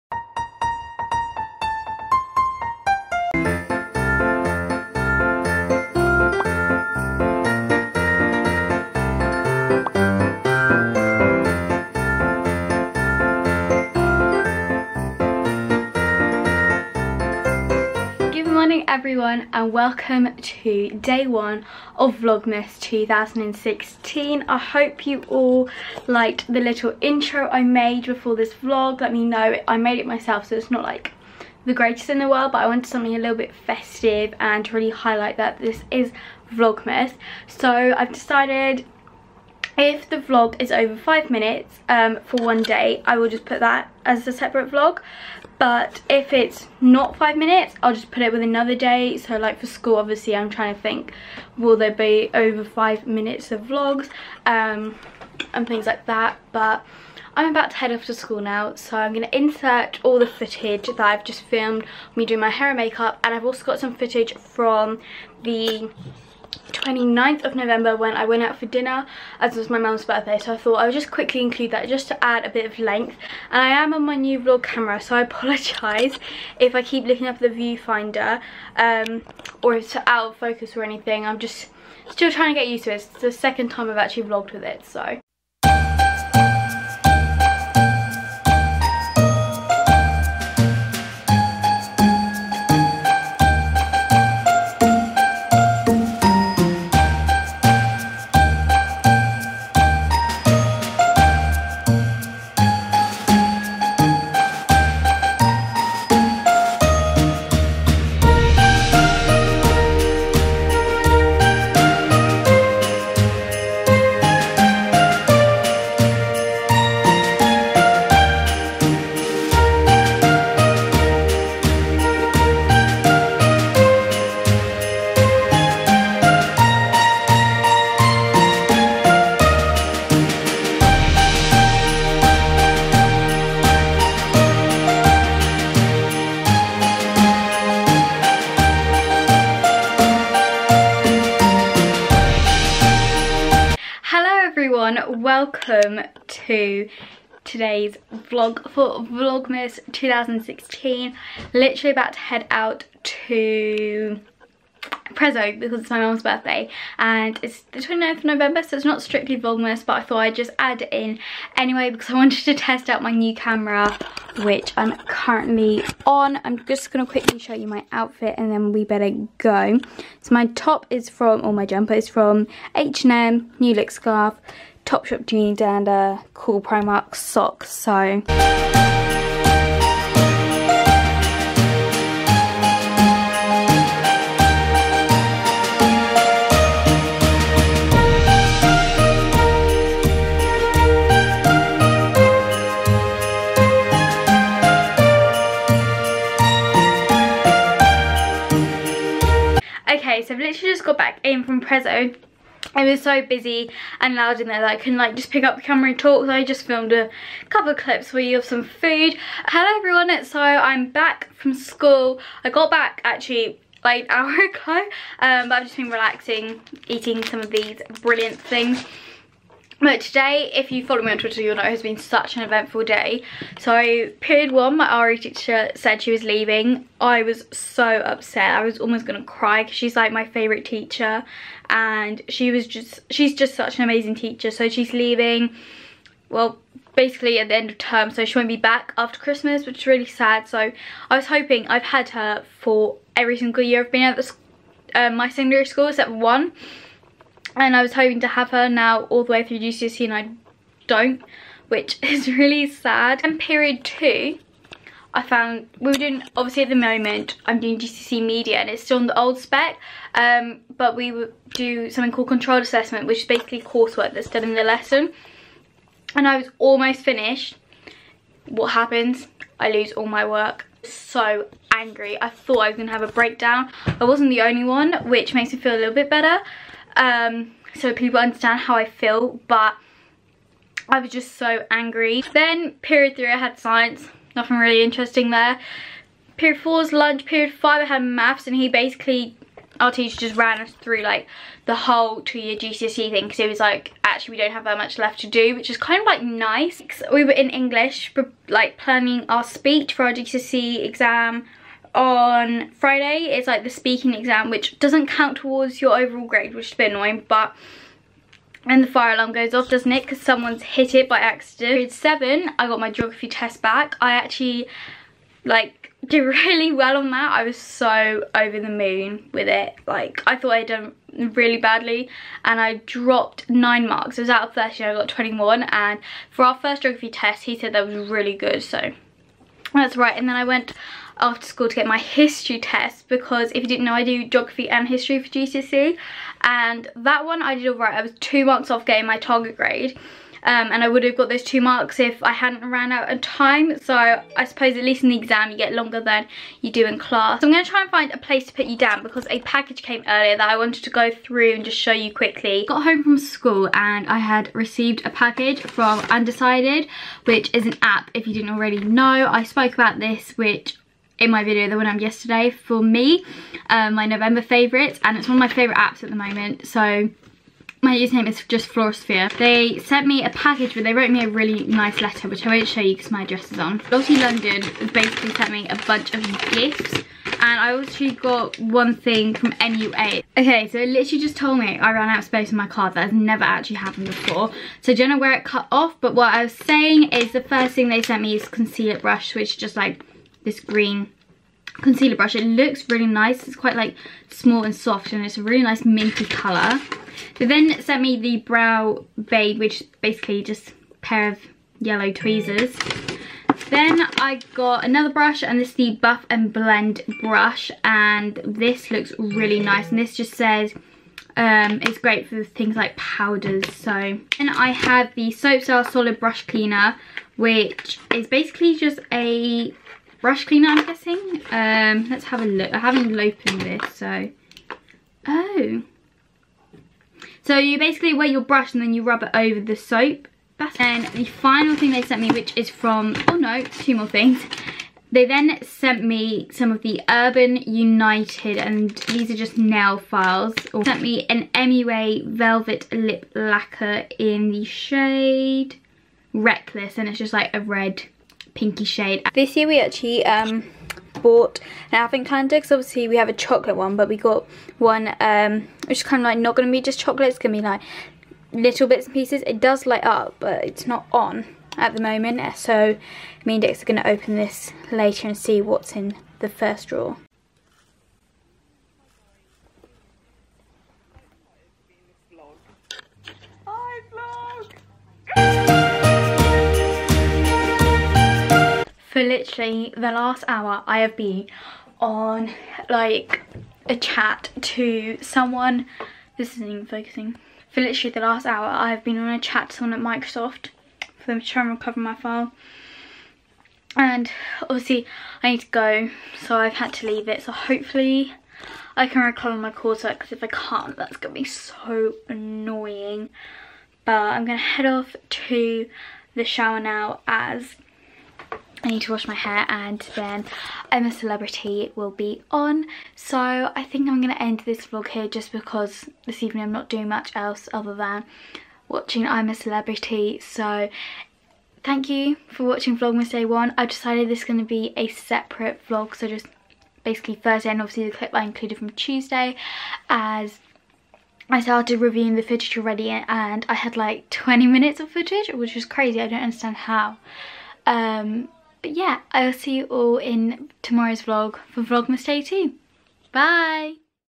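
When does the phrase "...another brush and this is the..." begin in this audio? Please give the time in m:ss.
6:44.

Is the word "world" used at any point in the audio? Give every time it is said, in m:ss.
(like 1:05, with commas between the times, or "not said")
0:32.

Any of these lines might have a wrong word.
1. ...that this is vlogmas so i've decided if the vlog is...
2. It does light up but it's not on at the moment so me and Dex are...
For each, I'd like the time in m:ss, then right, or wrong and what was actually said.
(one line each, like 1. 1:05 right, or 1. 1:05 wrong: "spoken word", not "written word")
1. 0:35 right
2. 7:39 right.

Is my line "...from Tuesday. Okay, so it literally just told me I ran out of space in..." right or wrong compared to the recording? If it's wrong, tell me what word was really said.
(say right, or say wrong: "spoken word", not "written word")
wrong: "MUA", not "Tuesday".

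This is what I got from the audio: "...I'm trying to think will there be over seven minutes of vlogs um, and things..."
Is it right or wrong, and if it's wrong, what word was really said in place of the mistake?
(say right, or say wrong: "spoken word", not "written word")
wrong: "five", not "seven".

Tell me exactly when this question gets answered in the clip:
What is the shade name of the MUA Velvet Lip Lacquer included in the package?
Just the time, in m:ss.
7:26.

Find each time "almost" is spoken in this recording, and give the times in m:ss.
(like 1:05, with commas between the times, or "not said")
3:48, 4:26.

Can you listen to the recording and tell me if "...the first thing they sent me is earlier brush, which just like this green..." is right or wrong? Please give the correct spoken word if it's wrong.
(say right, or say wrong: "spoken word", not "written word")
wrong: "concealer", not "earlier".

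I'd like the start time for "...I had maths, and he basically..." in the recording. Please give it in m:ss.
4:47.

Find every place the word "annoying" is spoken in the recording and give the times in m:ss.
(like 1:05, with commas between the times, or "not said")
5:06, 8:22.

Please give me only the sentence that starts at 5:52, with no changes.
Got home from school and I had received a package from Undecided which is an app if you didn't already know.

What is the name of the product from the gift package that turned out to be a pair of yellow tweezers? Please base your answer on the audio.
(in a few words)
Brow Babe.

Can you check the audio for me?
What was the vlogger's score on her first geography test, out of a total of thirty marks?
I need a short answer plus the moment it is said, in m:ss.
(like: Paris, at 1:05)
21, at 5:25.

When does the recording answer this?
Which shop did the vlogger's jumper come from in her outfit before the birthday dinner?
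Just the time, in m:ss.
2:52.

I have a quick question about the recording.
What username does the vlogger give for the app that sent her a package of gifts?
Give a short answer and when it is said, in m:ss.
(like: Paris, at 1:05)
floralsophia, at 6:08.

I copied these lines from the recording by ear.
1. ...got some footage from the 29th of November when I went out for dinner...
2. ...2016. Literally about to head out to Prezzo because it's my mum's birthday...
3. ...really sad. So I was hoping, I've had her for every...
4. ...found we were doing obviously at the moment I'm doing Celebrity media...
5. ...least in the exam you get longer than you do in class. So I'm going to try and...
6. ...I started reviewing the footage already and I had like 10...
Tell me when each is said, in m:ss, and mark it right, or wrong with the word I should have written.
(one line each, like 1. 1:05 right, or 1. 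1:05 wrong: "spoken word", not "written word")
1. 1:03 right
2. 2:29 right
3. 3:59 right
4. 4:15 wrong: "GCSE", not "Celebrity"
5. 5:44 right
6. 8:51 wrong: "20", not "10".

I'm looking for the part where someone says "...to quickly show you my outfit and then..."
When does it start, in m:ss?
2:47.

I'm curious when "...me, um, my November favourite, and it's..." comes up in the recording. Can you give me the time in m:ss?
6:02.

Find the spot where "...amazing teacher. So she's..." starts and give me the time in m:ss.
3:53.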